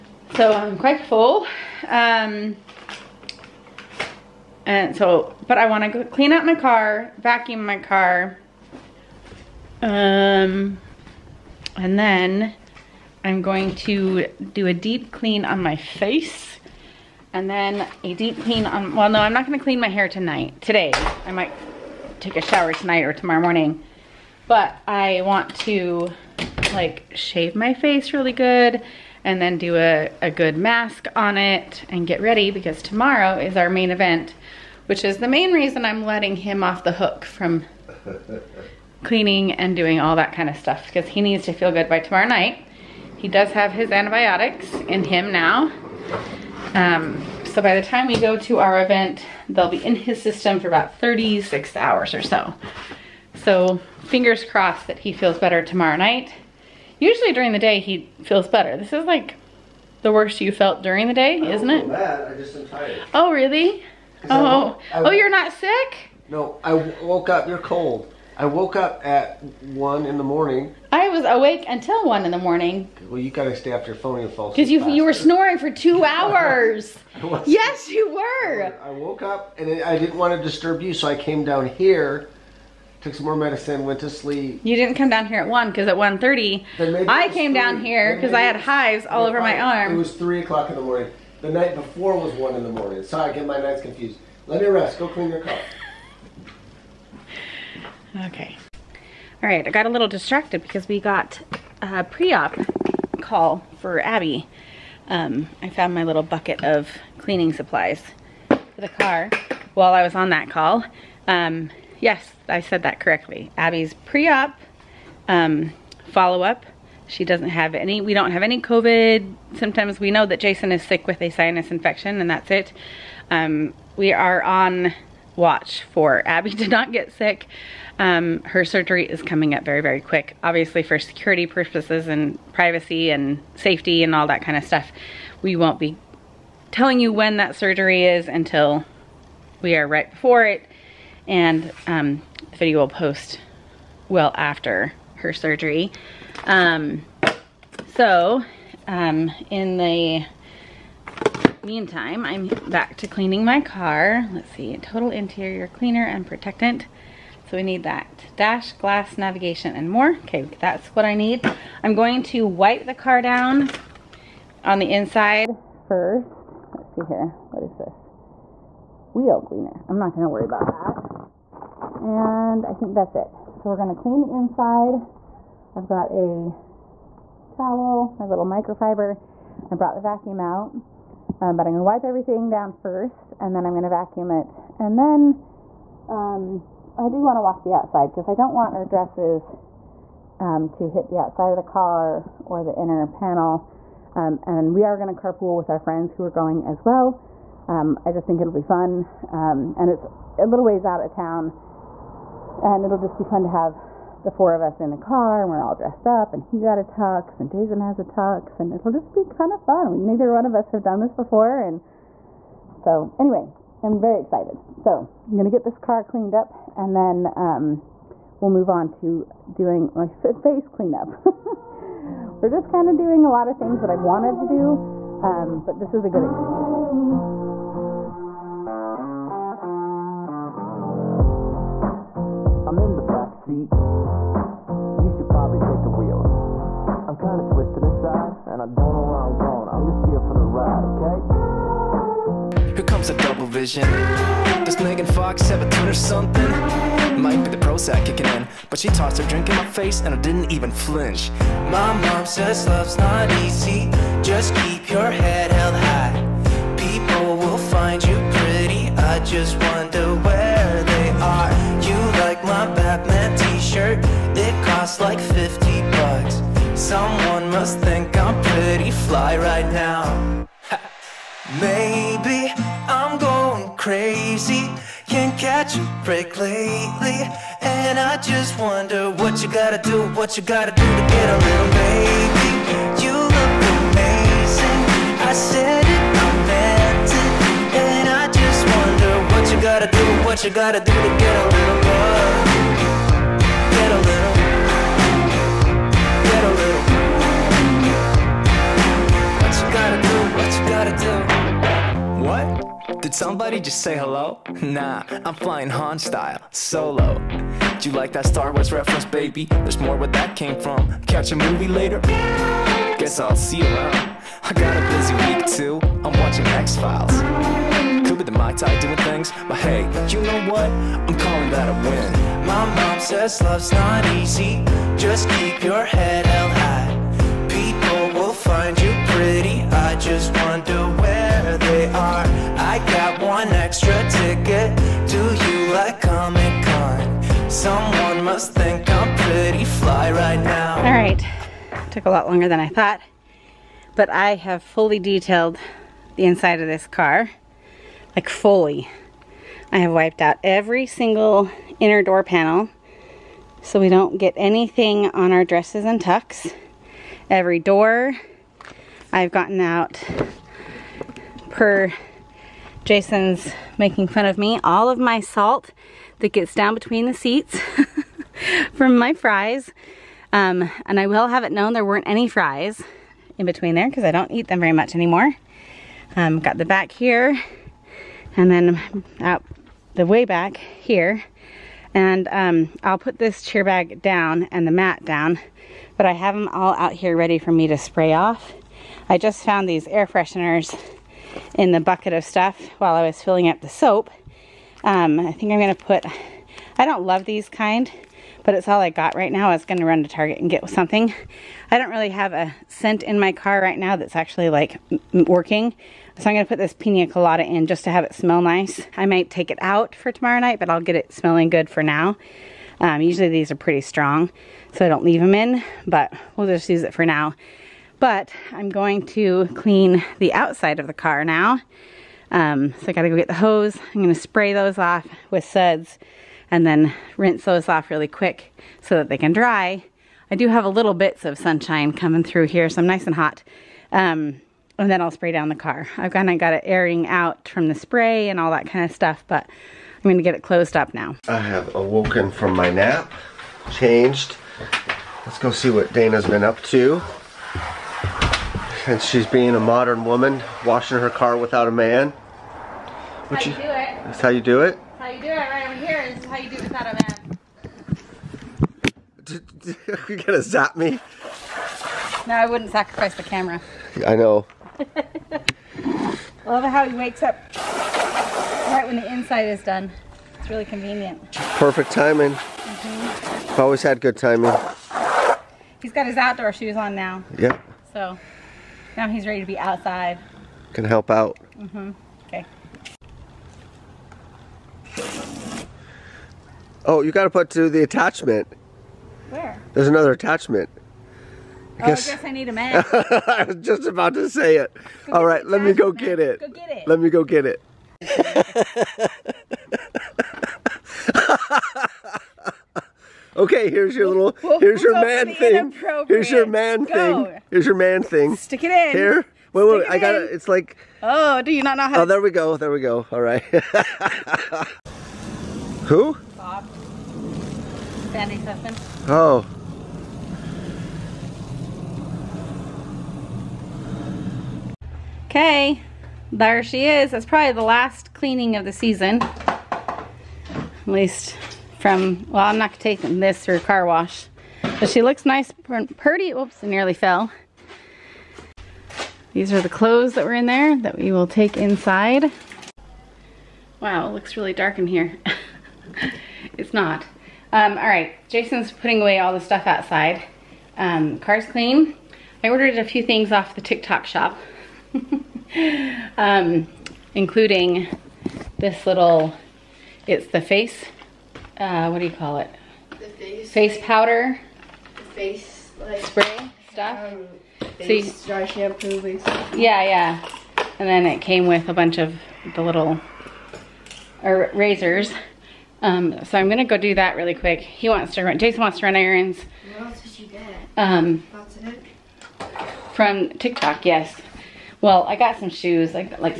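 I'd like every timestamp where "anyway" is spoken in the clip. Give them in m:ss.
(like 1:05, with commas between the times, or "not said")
3:33.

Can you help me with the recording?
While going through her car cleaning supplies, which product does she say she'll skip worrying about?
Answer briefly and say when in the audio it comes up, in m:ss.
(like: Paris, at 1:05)
Wheel cleaner, at 2:49.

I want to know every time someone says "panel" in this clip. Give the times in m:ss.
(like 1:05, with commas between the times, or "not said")
3:13, 5:52.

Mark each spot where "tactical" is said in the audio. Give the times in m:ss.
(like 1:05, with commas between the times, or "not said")
not said.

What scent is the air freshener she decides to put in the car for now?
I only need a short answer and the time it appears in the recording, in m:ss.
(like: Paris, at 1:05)
Pina colada, at 6:46.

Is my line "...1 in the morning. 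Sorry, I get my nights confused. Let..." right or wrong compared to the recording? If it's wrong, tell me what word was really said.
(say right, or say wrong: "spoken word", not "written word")
right.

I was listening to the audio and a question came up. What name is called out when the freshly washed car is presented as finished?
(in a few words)
Sandy Sussman.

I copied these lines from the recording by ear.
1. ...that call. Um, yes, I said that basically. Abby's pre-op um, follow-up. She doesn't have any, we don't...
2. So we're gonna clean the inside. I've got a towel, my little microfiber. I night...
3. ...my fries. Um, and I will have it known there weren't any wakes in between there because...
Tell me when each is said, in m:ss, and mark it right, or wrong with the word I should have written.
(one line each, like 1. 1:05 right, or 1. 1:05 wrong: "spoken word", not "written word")
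1. 1:50 wrong: "correctly", not "basically"
2. 2:53 wrong: "brought", not "night"
3. 6:08 wrong: "fries", not "wakes".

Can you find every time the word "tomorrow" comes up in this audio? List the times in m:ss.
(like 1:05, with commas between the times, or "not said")
0:23, 0:32, 0:42, 0:55, 6:50.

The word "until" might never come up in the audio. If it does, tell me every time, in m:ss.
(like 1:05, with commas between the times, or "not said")
1:11, 2:18.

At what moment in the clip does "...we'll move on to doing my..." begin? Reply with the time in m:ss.
3:38.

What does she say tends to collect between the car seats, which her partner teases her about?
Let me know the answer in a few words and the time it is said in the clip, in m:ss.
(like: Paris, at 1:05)
Salt, at 6:05.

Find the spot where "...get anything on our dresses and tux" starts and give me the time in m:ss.
5:54.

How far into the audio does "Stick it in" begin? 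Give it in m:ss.
8:28.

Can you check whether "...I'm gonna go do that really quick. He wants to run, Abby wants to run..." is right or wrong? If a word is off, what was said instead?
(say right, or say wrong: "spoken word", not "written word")
wrong: "Jason", not "Abby".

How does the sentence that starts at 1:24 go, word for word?
You didn't come down here at 1 because at 1.30, I came three.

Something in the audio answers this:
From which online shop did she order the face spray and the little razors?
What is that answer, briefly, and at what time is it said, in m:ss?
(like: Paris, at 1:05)
TikTok Shop, at 9:13.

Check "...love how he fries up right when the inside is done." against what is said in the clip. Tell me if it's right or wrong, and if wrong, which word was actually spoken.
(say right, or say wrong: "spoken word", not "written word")
wrong: "wakes", not "fries".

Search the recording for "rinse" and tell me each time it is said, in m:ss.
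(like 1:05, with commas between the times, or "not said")
7:07.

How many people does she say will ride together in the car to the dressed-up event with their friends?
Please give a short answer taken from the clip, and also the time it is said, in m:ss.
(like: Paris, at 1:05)
4, at 3:24.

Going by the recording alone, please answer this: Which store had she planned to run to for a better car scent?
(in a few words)
Target.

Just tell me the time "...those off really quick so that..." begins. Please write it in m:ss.
7:07.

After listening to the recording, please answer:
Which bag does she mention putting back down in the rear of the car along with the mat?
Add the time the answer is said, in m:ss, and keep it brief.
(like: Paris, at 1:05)
Cheer bag, at 6:23.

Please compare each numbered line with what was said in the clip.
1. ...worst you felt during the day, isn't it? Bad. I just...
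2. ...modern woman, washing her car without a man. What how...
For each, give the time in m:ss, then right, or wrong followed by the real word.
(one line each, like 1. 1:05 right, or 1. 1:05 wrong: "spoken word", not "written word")
1. 1:00 right
2. 7:29 right.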